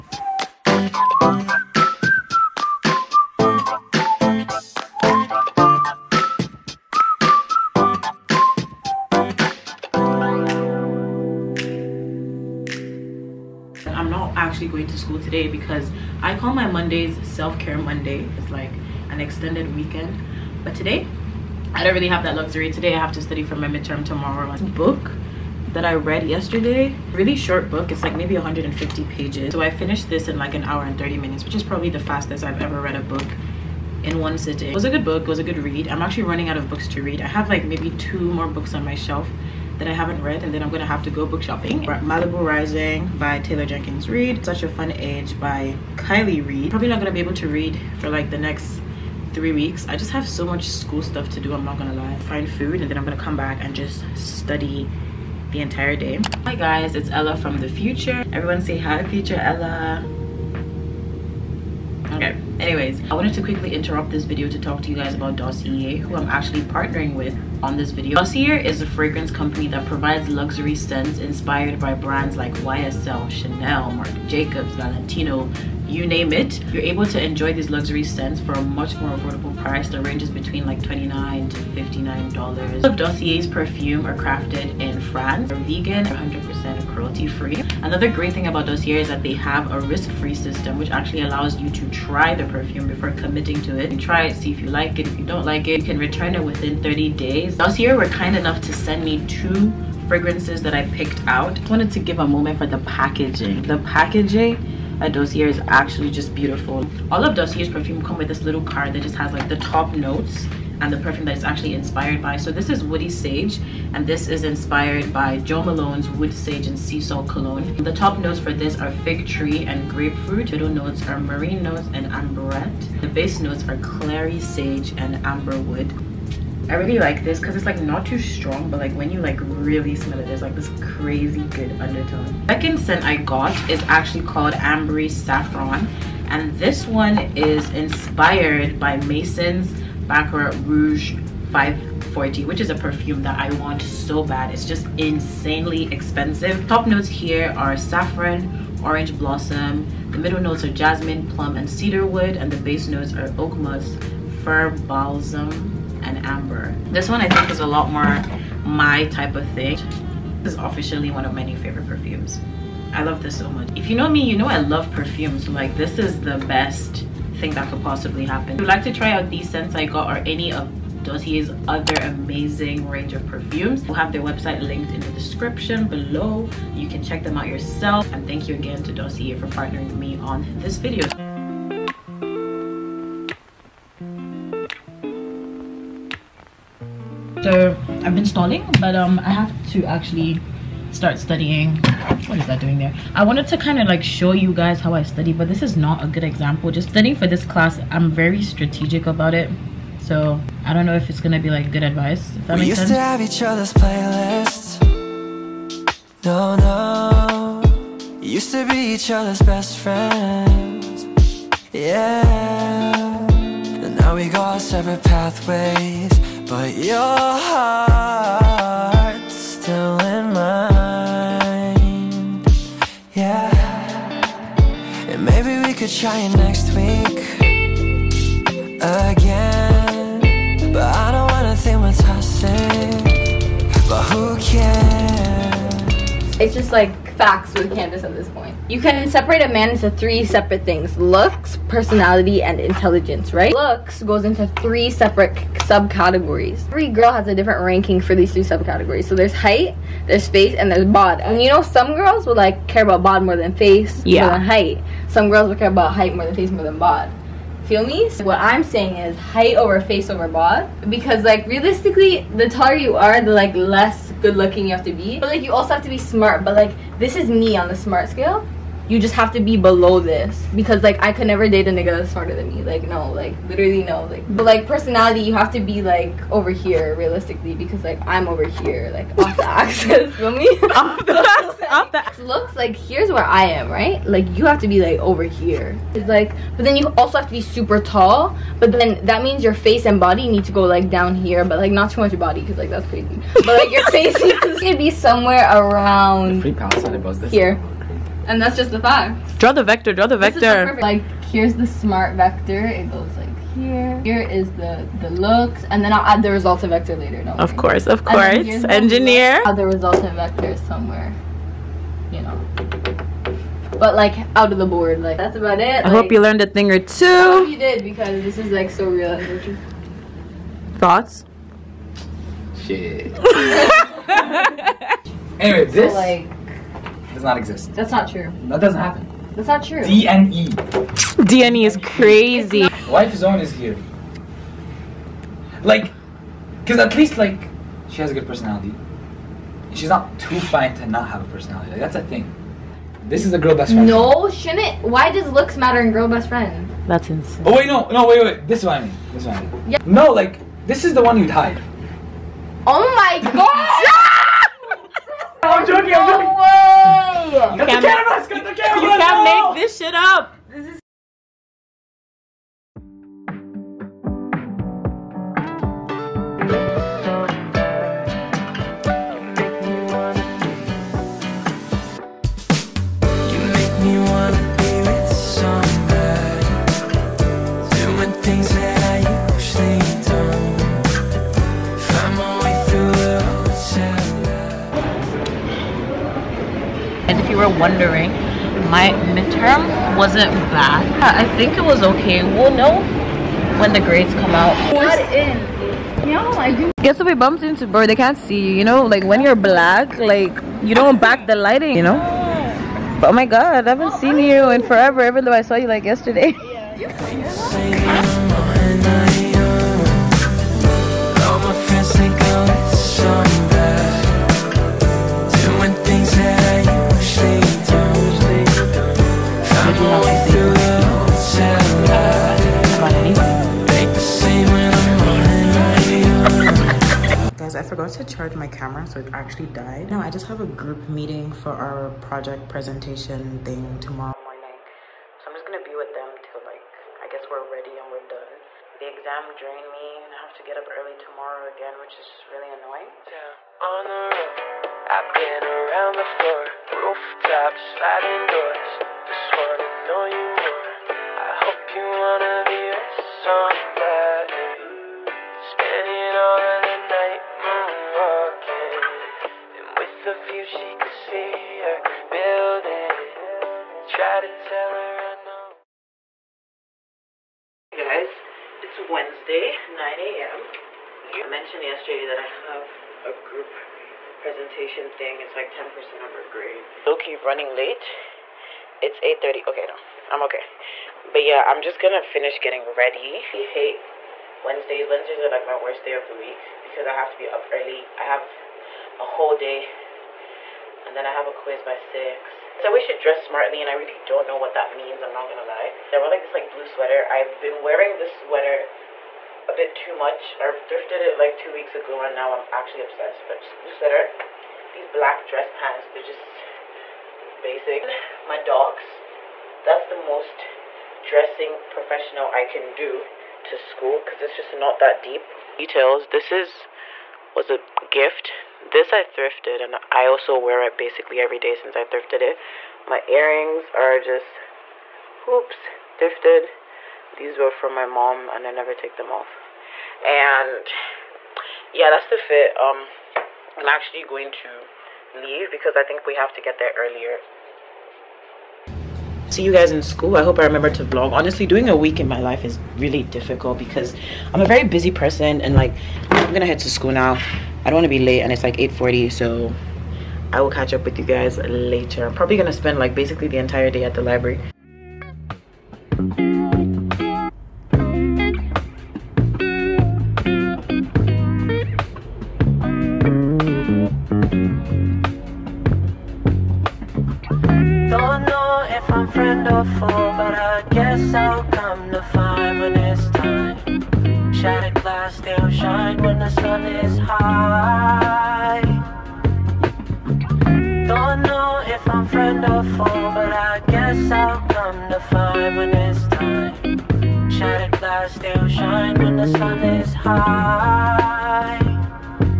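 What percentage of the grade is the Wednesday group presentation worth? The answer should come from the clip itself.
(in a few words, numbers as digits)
10%.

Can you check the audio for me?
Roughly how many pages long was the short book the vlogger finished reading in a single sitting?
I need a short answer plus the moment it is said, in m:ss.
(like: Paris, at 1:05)
150, at 0:28.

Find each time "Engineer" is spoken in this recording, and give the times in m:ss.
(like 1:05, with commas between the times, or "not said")
5:08.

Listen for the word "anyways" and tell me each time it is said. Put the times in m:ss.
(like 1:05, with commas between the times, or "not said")
1:02, 5:25.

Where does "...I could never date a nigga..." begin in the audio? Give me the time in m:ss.
4:31.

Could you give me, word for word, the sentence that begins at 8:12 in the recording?
So we should dress smartly and I really don't know what that means, I'm not gonna lie.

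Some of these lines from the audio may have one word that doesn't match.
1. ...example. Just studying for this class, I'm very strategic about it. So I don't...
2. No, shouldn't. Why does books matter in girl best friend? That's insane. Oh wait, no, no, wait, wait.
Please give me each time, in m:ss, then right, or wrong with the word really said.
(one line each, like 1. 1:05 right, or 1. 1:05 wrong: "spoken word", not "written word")
1. 3:16 right
2. 5:43 wrong: "looks", not "books".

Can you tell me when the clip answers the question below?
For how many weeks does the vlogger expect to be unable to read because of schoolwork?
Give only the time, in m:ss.
0:49.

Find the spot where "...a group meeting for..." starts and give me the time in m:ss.
7:10.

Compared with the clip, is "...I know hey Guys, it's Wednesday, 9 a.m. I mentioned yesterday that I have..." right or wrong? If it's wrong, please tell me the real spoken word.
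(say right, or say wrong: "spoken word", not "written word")
right.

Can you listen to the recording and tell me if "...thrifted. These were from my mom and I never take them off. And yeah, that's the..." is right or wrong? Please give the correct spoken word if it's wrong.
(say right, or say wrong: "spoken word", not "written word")
right.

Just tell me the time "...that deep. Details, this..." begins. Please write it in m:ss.
8:34.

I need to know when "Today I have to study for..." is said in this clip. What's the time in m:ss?
0:22.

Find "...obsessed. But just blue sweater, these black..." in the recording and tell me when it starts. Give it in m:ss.
8:22.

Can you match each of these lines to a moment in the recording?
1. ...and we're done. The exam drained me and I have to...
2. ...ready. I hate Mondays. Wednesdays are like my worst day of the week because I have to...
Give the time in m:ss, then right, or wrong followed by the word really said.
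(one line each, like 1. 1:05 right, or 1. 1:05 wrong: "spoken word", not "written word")
1. 7:17 right
2. 8:02 wrong: "Wednesdays", not "Mondays".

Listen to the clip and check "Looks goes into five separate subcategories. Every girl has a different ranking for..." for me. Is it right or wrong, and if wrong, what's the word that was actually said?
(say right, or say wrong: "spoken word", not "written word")
wrong: "three", not "five".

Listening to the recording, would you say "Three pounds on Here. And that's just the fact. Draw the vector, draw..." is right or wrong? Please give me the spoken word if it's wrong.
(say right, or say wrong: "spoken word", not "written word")
right.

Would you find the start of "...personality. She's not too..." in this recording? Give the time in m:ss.
5:38.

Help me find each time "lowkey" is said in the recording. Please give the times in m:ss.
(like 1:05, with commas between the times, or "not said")
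7:56.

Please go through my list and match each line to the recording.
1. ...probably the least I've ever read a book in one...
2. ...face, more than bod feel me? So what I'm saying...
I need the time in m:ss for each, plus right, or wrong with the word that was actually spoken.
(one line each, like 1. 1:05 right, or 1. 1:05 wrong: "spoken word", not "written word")
1. 0:31 wrong: "fastest", not "least"
2. 4:16 right.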